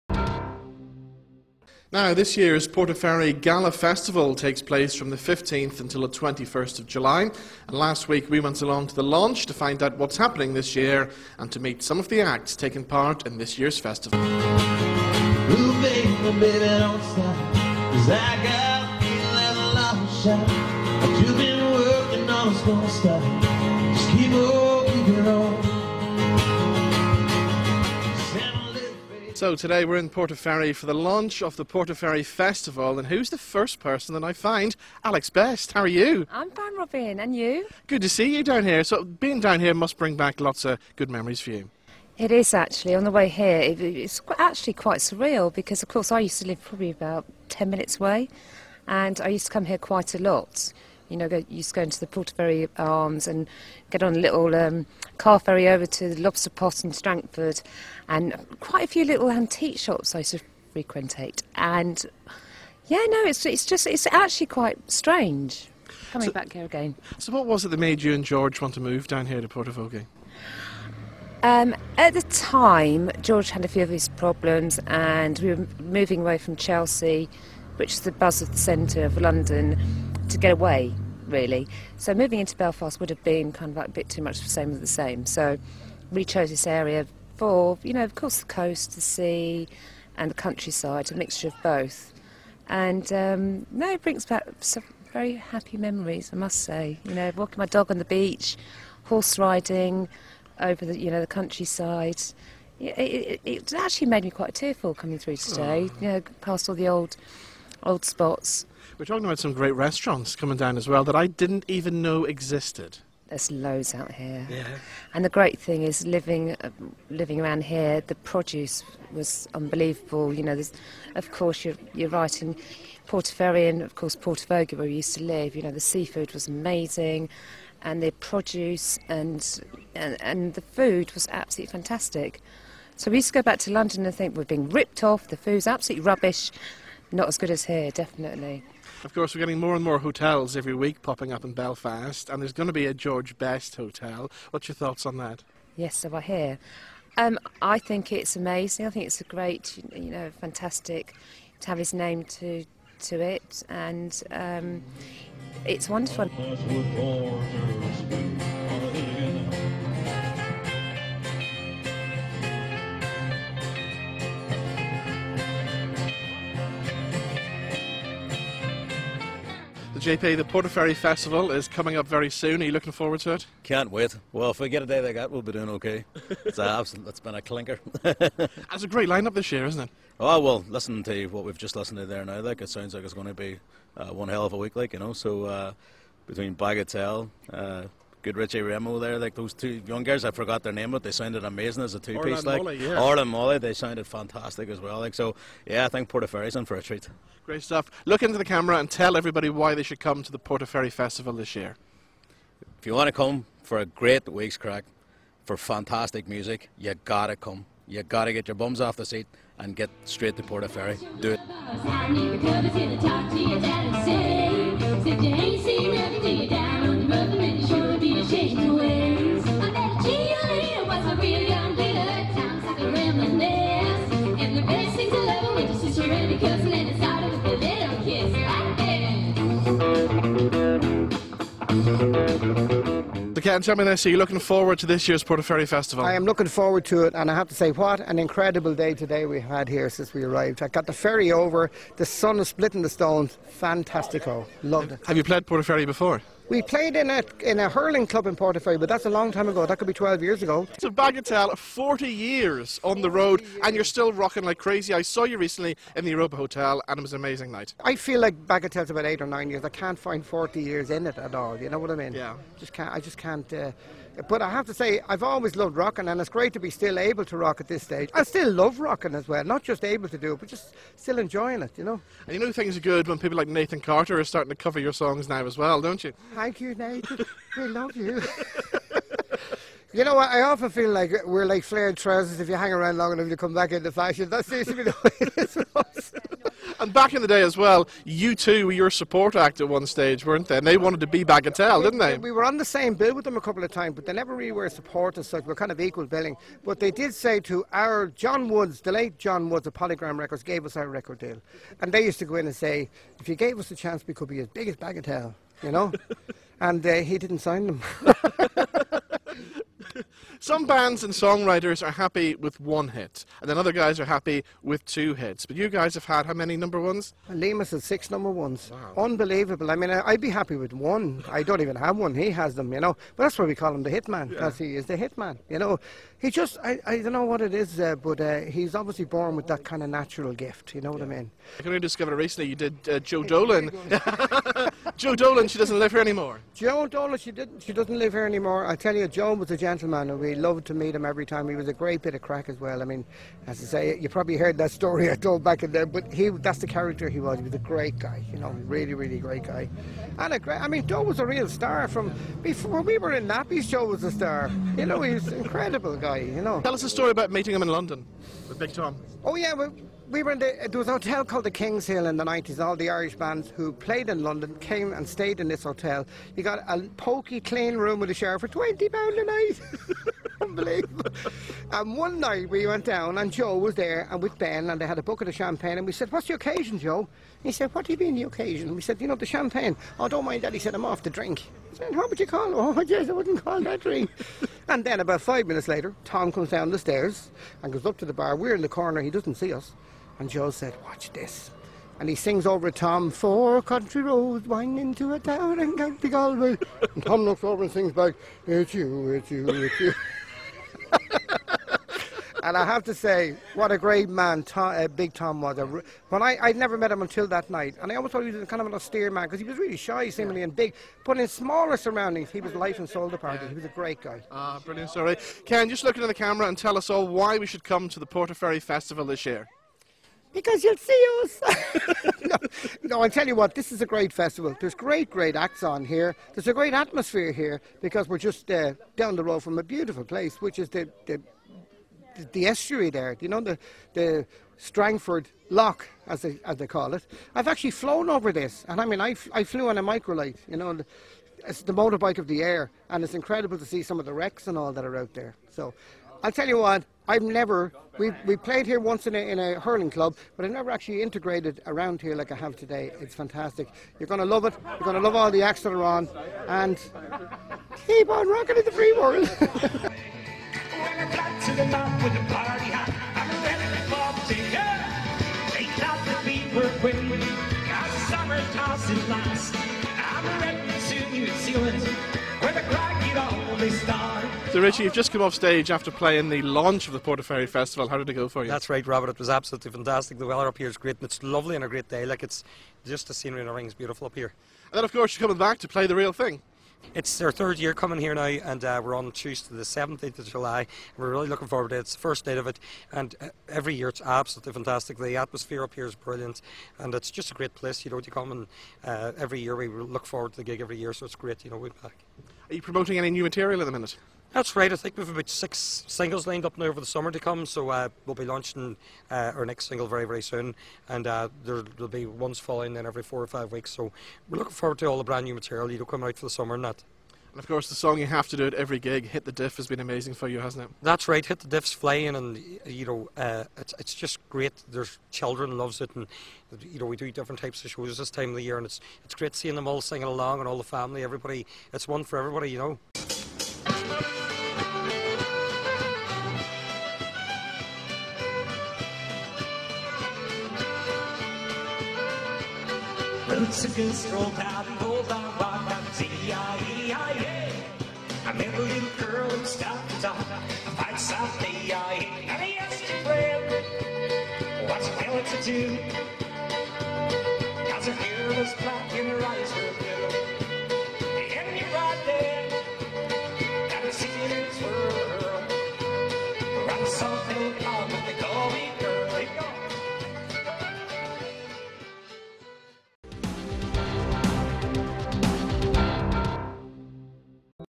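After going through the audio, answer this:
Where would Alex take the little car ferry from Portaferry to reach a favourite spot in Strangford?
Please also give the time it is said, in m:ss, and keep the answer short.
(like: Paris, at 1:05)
The Lobster Pot, at 0:56.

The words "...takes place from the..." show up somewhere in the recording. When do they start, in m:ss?
0:04.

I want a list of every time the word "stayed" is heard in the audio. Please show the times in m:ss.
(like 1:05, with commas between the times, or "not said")
6:05.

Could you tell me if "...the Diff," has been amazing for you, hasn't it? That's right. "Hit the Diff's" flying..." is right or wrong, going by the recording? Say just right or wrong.
right.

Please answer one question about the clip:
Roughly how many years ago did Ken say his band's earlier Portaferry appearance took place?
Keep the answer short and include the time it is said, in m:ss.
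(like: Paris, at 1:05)
12 years, at 4:09.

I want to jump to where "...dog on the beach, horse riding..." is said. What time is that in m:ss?
1:37.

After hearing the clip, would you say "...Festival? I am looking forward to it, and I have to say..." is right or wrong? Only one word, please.
right.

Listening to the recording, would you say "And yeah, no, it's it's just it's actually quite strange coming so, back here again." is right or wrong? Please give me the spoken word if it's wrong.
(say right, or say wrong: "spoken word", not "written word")
right.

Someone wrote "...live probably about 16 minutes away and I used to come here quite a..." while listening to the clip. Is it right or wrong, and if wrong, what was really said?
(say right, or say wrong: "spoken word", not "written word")
wrong: "10", not "16".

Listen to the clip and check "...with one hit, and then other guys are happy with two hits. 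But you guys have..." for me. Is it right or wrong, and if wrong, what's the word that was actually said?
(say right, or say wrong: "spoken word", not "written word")
right.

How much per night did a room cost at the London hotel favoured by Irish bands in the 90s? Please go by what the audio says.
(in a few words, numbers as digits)
£20.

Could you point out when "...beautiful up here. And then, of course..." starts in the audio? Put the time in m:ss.
8:03.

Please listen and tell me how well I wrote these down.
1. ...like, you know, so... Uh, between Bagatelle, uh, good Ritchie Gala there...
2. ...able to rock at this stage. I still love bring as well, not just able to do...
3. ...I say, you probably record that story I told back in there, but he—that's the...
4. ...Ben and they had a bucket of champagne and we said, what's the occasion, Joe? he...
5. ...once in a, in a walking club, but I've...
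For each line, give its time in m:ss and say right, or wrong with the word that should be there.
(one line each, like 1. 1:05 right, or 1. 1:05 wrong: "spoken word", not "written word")
1. 3:04 wrong: "Remo", not "Gala"
2. 4:26 wrong: "rocking", not "bring"
3. 5:43 wrong: "heard", not "record"
4. 6:14 right
5. 7:28 wrong: "hurling", not "walking".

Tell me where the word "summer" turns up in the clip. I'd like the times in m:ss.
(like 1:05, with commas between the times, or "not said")
8:26, 8:36.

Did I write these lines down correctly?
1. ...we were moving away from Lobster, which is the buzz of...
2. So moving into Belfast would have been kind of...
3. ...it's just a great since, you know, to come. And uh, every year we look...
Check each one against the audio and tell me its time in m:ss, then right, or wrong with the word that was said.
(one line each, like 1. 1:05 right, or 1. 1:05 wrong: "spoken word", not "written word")
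1. 1:15 wrong: "Chelsea", not "Lobster"
2. 1:21 right
3. 8:16 wrong: "place", not "since".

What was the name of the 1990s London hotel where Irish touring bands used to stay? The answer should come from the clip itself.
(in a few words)
King's Hill.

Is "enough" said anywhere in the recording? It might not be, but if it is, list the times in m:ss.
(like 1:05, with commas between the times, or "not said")
4:43.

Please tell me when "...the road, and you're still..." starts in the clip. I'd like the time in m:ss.
4:13.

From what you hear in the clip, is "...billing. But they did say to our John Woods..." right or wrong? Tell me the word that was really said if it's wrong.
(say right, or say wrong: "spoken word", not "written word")
right.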